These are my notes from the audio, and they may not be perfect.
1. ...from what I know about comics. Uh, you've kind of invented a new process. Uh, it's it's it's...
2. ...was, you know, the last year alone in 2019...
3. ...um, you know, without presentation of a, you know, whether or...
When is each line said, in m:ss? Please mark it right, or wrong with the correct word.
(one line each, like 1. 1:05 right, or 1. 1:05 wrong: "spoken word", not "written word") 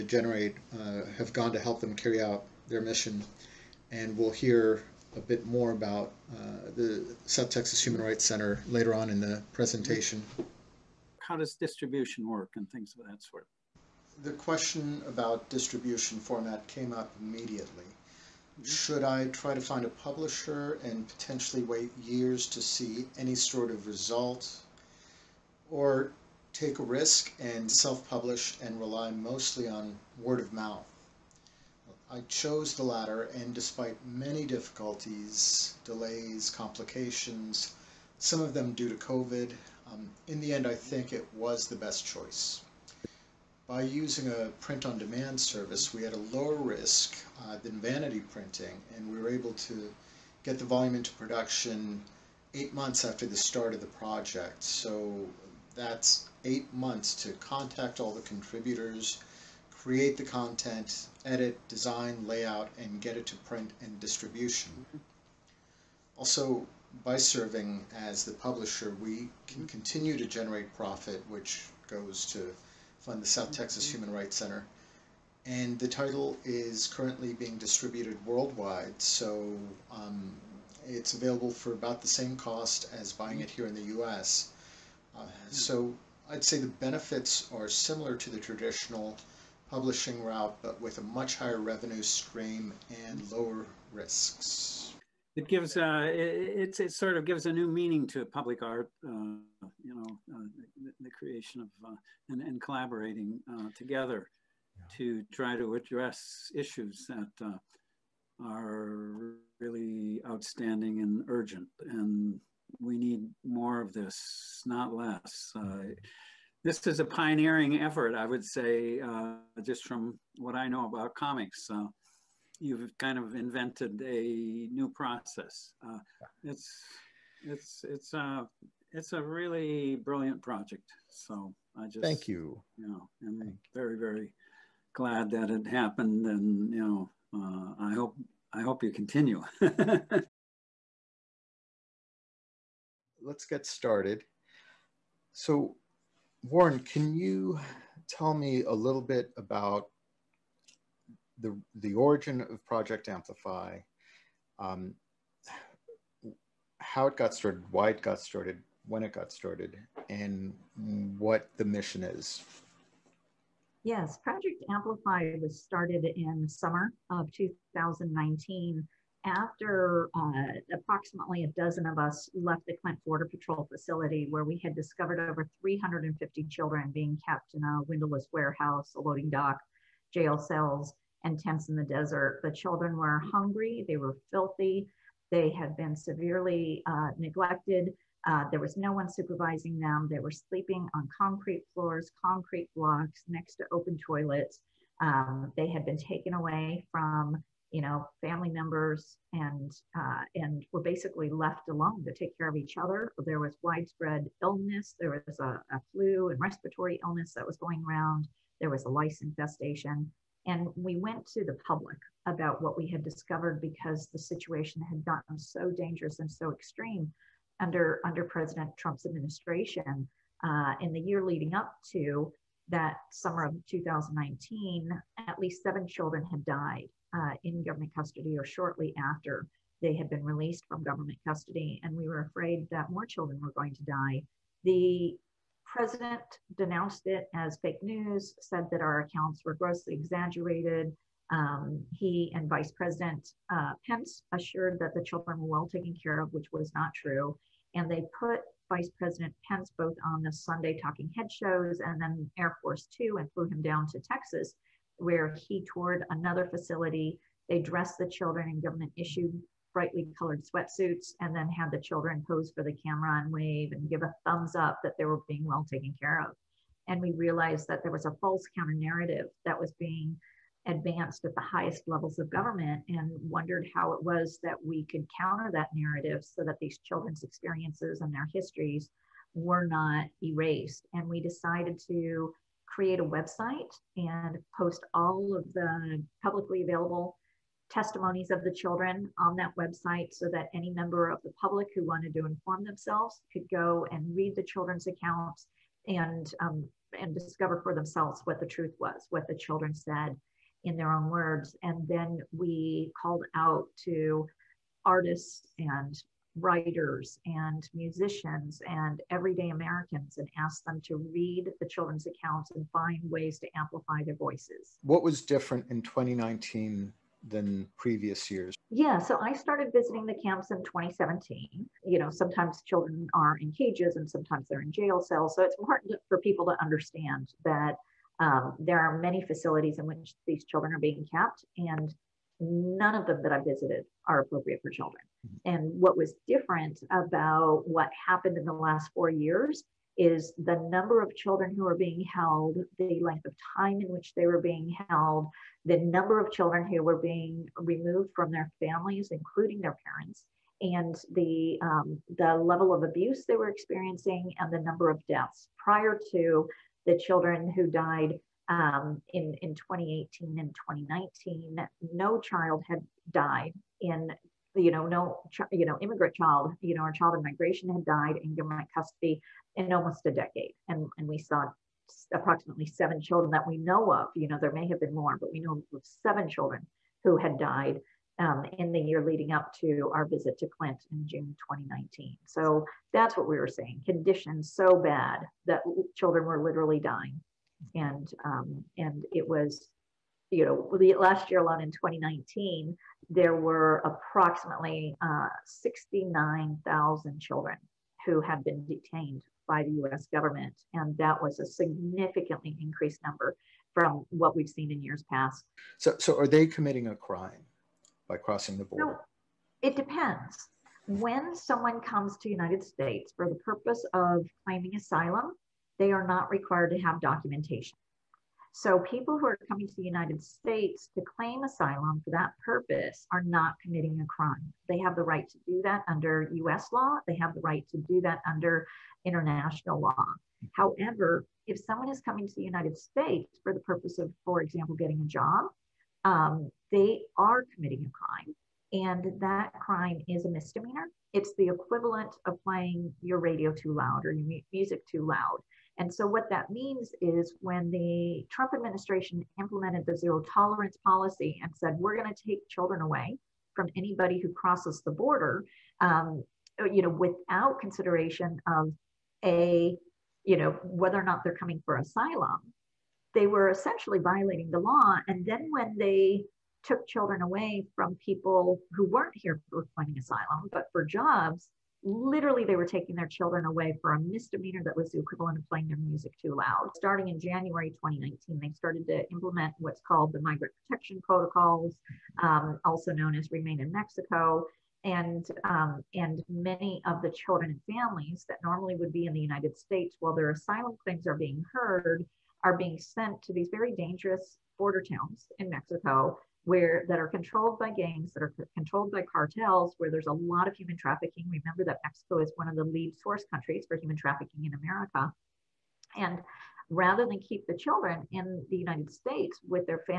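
1. 1:59 right
2. 6:29 right
3. 7:35 wrong: "consideration", not "presentation".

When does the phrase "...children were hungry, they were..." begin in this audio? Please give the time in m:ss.
3:02.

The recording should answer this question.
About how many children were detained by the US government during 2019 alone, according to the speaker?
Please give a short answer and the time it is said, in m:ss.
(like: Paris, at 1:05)
69,000, at 6:35.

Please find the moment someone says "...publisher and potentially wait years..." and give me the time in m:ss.
0:19.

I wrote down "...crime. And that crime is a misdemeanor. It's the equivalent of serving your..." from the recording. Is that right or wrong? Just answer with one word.
wrong.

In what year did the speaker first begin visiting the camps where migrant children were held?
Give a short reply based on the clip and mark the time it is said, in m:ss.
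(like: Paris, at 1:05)
2017, at 5:20.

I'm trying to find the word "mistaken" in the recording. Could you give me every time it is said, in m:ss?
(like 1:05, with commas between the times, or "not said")
not said.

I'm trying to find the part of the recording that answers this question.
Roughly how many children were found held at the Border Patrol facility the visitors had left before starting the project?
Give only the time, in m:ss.
2:55.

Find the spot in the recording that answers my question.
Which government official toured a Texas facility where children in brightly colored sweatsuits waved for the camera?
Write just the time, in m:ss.
4:08.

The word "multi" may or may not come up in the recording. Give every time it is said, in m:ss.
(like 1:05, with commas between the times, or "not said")
not said.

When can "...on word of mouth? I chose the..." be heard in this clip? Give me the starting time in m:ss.
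0:29.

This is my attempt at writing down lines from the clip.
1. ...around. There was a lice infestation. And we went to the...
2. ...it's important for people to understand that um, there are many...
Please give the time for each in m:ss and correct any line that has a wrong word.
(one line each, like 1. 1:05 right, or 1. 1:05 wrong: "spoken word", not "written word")
1. 3:27 right
2. 5:25 right.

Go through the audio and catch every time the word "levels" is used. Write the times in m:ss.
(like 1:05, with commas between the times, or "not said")
4:31, 5:52.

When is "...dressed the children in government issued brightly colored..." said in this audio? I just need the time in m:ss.
4:17.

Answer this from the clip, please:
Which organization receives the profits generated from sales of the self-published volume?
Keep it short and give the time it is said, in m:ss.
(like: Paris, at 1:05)
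South Texas Human Rights Center, at 1:13.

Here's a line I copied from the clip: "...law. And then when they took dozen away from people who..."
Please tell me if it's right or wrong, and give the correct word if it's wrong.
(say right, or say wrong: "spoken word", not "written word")
wrong: "children", not "dozen".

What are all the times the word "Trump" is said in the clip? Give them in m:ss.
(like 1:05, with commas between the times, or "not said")
3:38, 7:28.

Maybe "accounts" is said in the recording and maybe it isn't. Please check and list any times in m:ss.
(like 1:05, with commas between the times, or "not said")
3:58, 4:54, 5:12.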